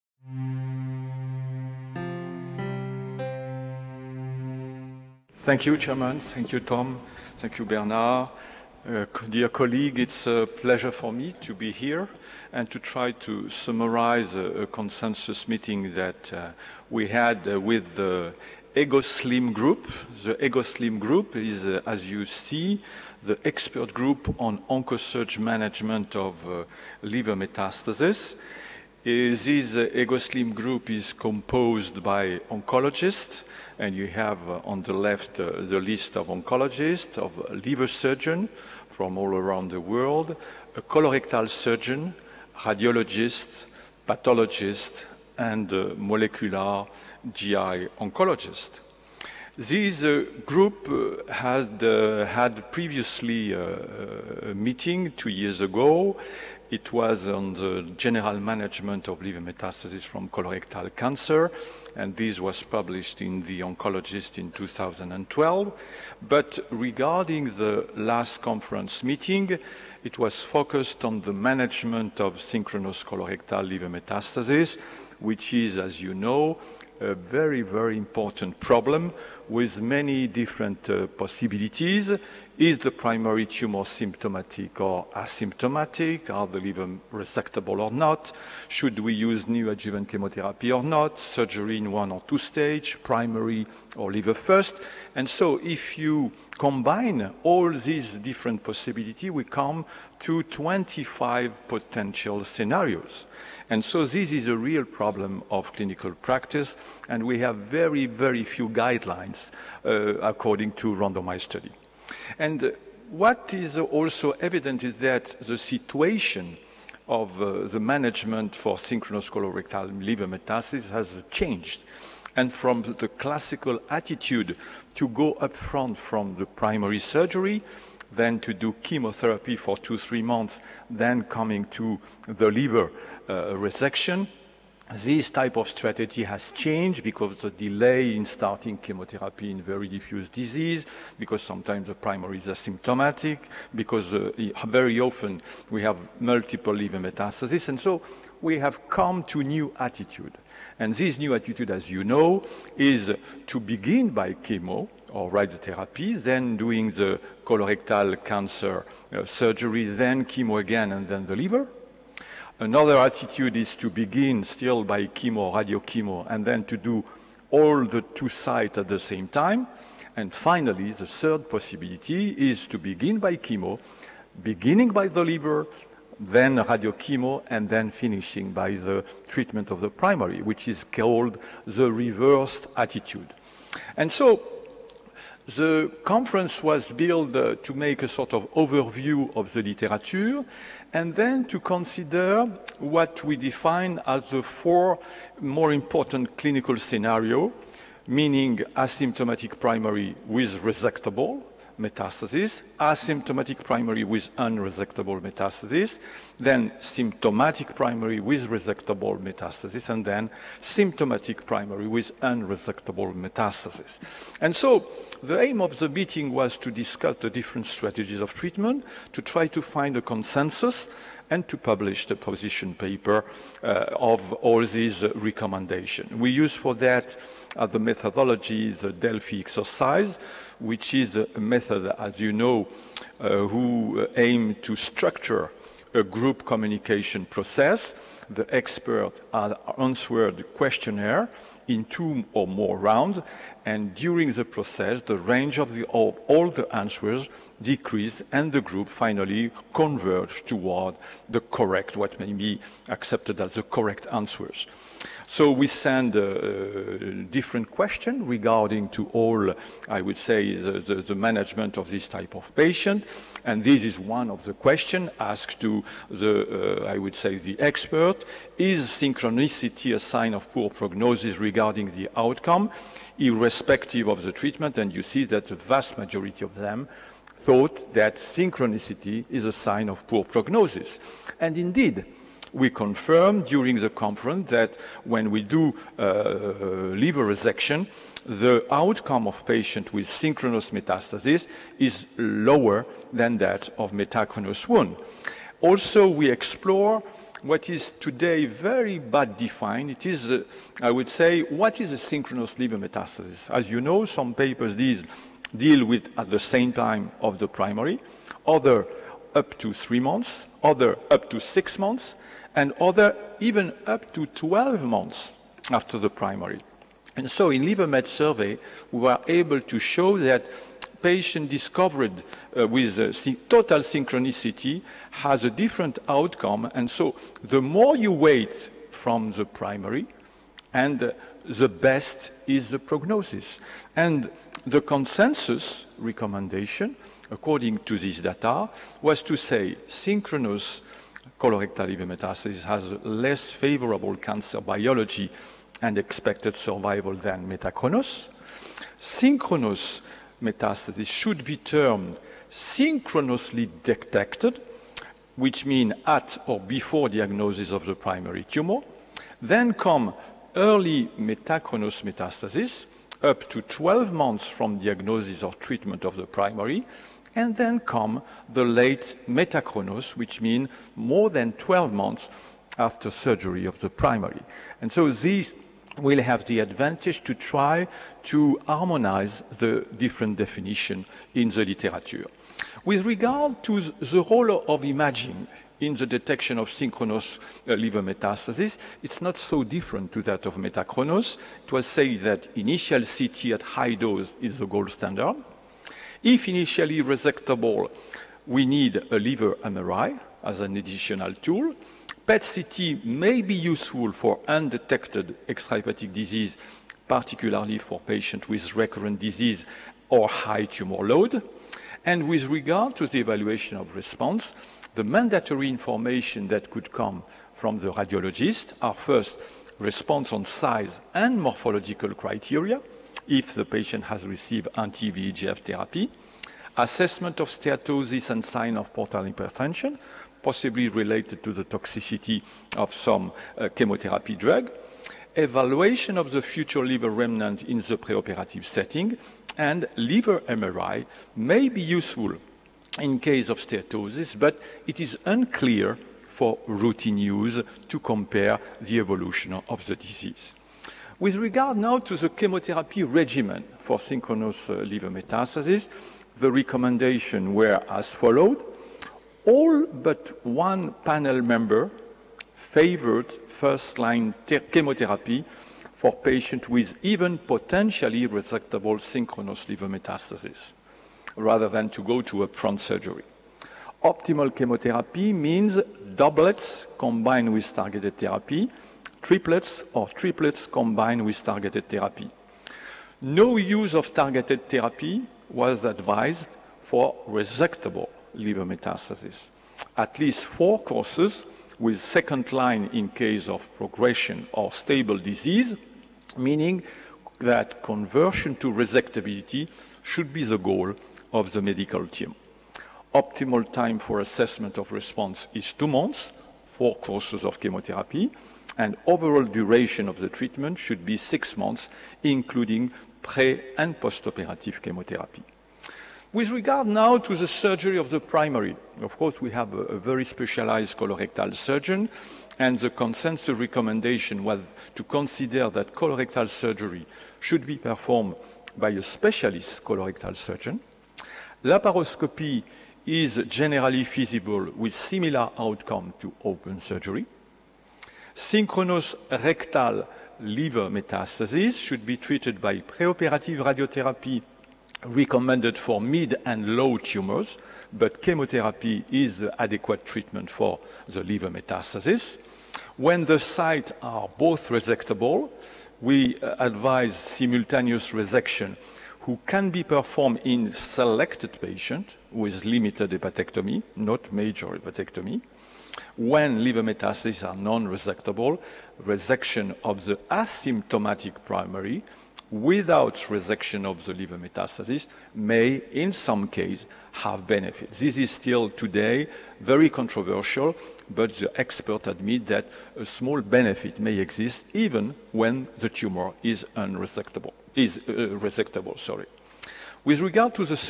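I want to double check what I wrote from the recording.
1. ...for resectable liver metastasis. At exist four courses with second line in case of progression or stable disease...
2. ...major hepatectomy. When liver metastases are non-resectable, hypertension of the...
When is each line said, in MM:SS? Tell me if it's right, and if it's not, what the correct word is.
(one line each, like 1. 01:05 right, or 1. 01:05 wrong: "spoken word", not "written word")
1. 08:06 wrong: "least", not "exist"
2. 09:24 wrong: "resection", not "hypertension".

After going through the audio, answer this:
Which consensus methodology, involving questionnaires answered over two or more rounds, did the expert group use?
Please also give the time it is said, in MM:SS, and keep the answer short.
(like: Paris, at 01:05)
Delphi exercise, at 03:48.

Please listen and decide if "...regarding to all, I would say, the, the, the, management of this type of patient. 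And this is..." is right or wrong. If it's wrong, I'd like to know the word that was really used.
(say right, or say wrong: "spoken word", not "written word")
right.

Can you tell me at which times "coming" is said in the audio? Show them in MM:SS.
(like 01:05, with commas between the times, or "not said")
02:11.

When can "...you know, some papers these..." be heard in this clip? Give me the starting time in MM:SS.
05:03.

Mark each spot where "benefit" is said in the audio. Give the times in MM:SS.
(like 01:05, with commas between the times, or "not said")
09:37, 09:43.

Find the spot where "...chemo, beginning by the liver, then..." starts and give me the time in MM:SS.
02:53.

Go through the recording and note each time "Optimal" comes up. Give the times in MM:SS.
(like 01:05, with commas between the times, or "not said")
07:54, 08:23.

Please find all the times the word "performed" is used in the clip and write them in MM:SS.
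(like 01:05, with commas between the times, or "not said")
08:47, 09:19.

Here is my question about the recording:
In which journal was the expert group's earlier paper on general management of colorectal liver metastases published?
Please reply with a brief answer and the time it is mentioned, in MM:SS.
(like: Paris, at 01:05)
The Oncologist, at 01:03.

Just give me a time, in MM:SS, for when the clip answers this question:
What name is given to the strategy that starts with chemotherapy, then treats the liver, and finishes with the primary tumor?
03:01.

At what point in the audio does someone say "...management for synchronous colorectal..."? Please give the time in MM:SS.
01:57.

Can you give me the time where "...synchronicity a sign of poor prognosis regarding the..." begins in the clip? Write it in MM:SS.
04:28.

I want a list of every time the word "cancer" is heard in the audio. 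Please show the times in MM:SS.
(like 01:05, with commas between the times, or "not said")
01:00, 02:38, 05:44.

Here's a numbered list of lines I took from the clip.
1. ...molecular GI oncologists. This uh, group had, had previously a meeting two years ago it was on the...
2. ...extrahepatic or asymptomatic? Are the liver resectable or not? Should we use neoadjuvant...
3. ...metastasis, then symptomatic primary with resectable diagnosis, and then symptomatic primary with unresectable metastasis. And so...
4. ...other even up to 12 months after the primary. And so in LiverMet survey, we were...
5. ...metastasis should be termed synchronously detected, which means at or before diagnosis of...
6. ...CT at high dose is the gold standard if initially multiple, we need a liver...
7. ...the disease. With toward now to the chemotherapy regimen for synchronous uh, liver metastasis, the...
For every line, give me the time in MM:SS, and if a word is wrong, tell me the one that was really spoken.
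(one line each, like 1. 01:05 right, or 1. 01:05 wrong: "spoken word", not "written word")
1. 00:45 right
2. 01:23 wrong: "symptomatic", not "extrahepatic"
3. 03:25 wrong: "metastasis", not "diagnosis"
4. 05:12 right
5. 05:50 right
6. 06:33 wrong: "resectable", not "multiple"
7. 07:29 wrong: "regard", not "toward".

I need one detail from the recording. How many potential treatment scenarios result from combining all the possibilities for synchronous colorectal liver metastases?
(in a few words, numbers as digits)
25.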